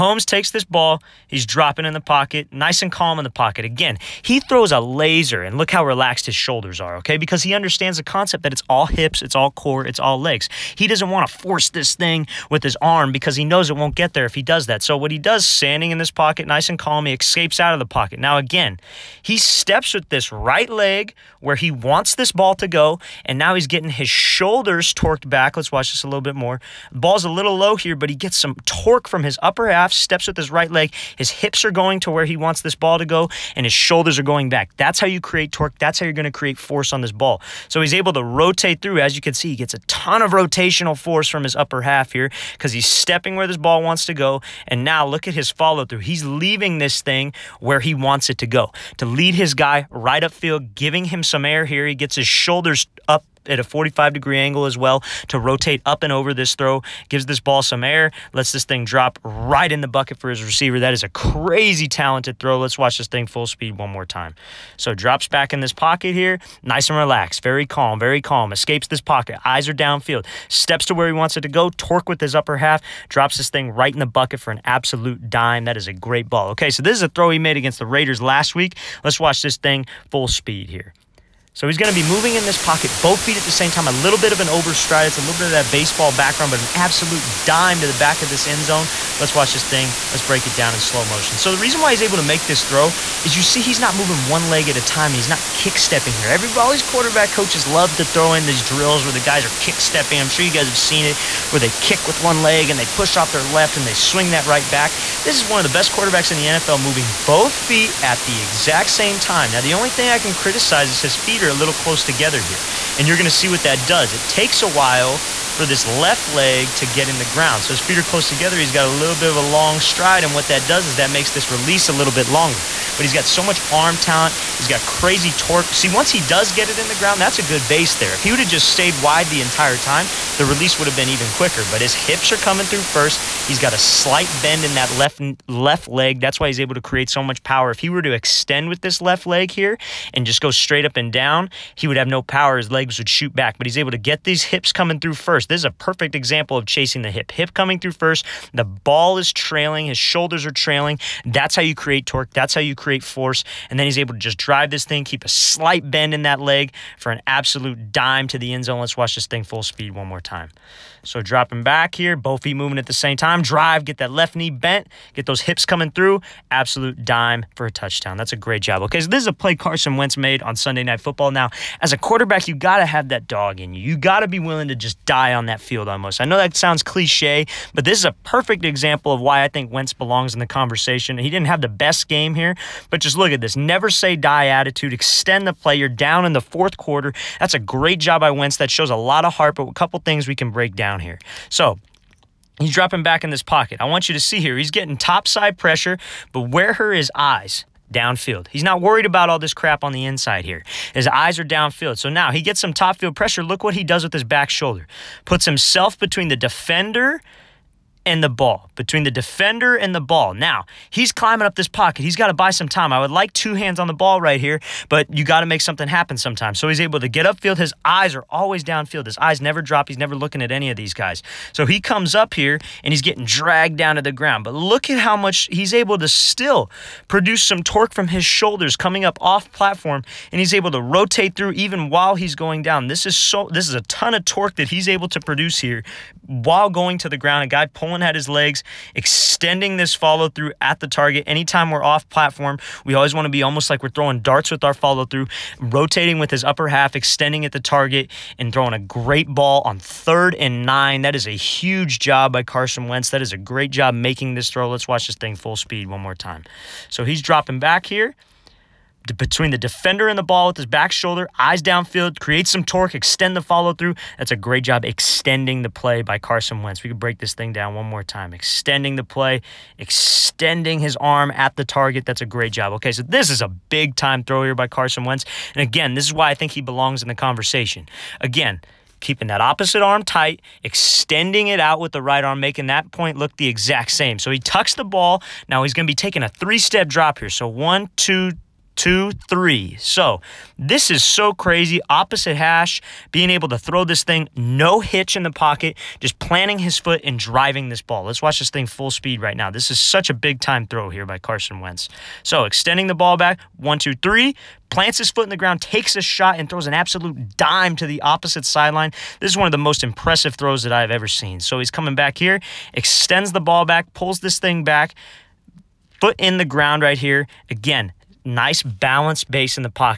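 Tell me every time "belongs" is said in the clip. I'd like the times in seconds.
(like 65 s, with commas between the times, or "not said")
179 s, 276 s.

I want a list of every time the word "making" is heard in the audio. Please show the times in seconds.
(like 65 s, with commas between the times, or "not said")
253 s, 282 s.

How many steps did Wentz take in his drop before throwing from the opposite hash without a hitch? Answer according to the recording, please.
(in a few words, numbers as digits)
3.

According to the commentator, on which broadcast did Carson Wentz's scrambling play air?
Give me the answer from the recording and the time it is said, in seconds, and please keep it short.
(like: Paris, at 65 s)
Sunday Night Football, at 170 s.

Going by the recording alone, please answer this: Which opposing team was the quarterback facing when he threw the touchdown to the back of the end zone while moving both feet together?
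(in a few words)
Raiders.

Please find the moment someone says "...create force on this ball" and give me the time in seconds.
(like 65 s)
36 s.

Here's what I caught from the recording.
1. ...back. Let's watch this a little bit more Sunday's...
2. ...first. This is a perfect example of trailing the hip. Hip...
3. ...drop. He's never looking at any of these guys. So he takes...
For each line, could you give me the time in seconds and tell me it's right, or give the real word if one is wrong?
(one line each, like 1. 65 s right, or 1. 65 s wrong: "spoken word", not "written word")
1. 25 s wrong: "Ball", not "Sunday"
2. 145 s wrong: "chasing", not "trailing"
3. 219 s wrong: "comes", not "takes".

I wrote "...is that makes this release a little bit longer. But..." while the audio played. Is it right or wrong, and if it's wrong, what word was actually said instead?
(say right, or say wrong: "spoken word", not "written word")
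right.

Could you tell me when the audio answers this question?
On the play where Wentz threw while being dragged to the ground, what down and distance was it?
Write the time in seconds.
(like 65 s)
249 s.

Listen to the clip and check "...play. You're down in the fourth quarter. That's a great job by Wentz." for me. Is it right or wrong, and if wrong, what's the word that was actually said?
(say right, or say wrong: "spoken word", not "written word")
right.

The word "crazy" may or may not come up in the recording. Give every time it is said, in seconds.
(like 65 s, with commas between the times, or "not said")
61 s, 124 s, 291 s.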